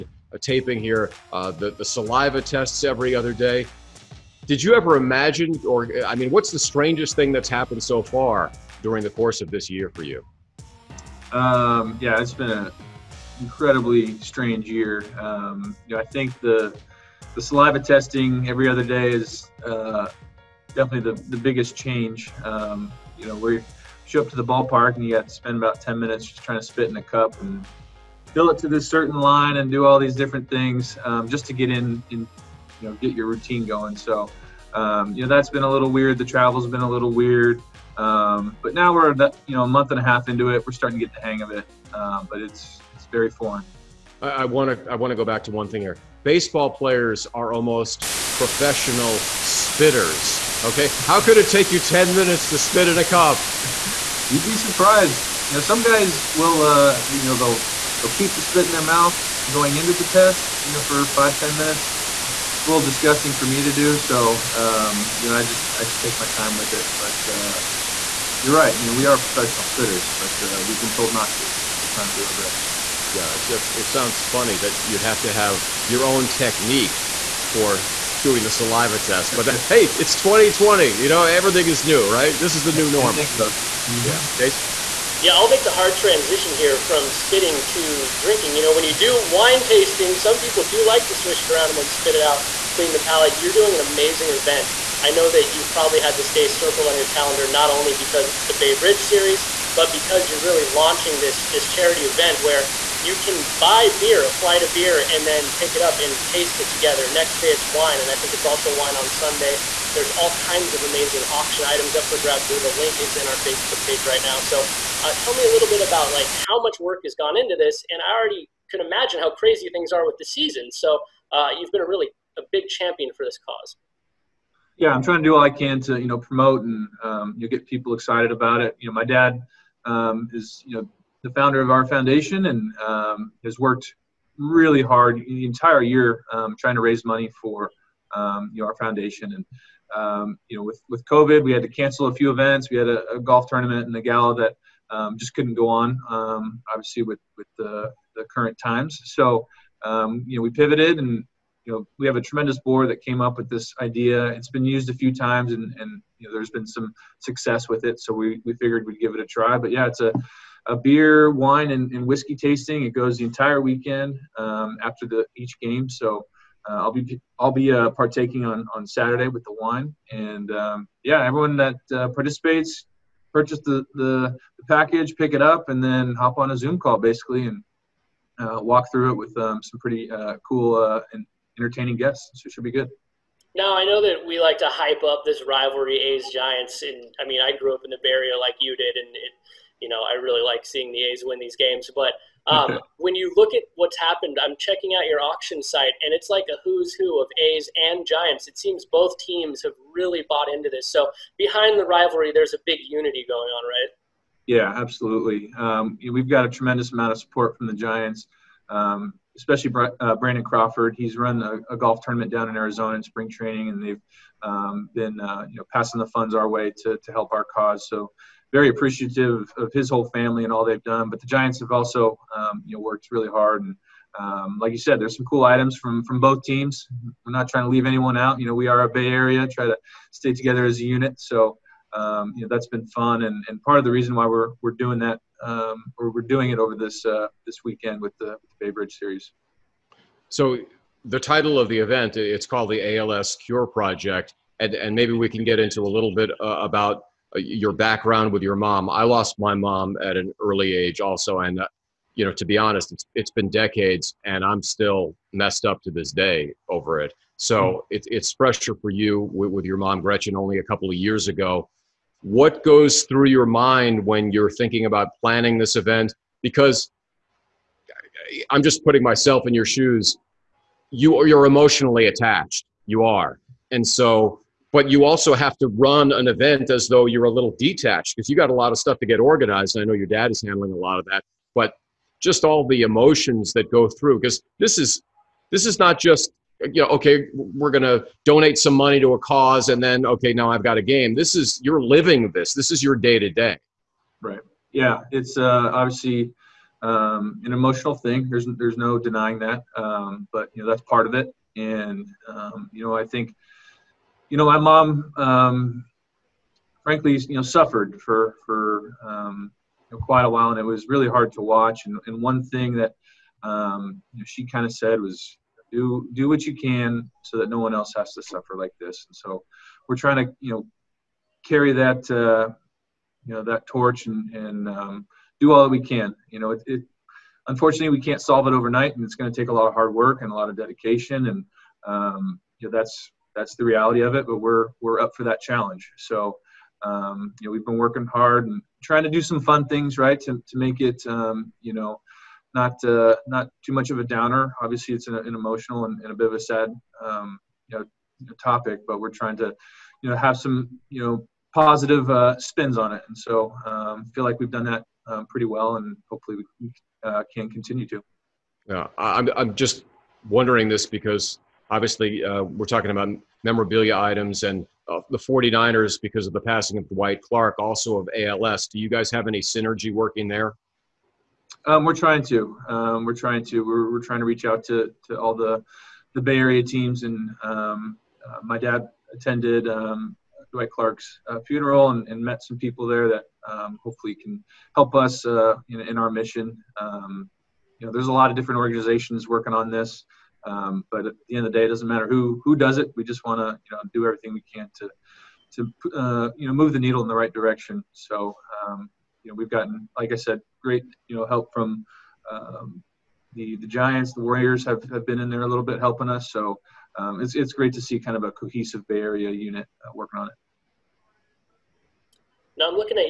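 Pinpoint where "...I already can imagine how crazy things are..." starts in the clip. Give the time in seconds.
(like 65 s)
118 s.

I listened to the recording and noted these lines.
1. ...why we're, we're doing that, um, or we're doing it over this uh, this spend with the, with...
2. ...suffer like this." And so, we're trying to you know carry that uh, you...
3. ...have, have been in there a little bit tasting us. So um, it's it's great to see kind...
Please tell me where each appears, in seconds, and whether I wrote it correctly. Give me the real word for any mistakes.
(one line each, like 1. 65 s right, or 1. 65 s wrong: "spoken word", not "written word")
1. 234 s wrong: "weekend", not "spend"
2. 318 s right
3. 404 s wrong: "helping", not "tasting".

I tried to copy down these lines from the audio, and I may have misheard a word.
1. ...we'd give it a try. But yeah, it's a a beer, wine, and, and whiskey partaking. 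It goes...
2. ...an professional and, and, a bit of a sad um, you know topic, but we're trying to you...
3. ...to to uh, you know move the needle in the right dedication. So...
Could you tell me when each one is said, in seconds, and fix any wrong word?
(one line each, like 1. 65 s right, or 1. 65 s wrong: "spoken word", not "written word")
1. 158 s wrong: "tasting", not "partaking"
2. 345 s wrong: "emotional", not "professional"
3. 394 s wrong: "direction", not "dedication".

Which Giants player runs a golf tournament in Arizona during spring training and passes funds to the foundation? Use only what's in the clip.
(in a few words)
Brandon Crawford.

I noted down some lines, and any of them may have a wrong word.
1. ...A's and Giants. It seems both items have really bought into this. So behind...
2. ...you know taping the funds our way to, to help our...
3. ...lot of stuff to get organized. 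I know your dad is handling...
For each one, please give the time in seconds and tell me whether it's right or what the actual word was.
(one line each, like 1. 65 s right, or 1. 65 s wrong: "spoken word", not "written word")
1. 197 s wrong: "teams", not "items"
2. 215 s wrong: "passing", not "taping"
3. 278 s right.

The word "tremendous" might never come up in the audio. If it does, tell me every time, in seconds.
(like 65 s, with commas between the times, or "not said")
152 s, 206 s.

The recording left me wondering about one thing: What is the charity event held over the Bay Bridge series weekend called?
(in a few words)
ALS Cure Project.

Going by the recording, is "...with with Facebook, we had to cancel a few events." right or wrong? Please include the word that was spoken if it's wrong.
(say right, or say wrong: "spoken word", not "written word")
wrong: "COVID", not "Facebook".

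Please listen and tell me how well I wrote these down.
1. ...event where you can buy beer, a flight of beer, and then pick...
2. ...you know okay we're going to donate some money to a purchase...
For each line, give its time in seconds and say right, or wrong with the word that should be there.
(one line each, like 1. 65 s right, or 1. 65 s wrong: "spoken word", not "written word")
1. 102 s right
2. 286 s wrong: "cause", not "purchase".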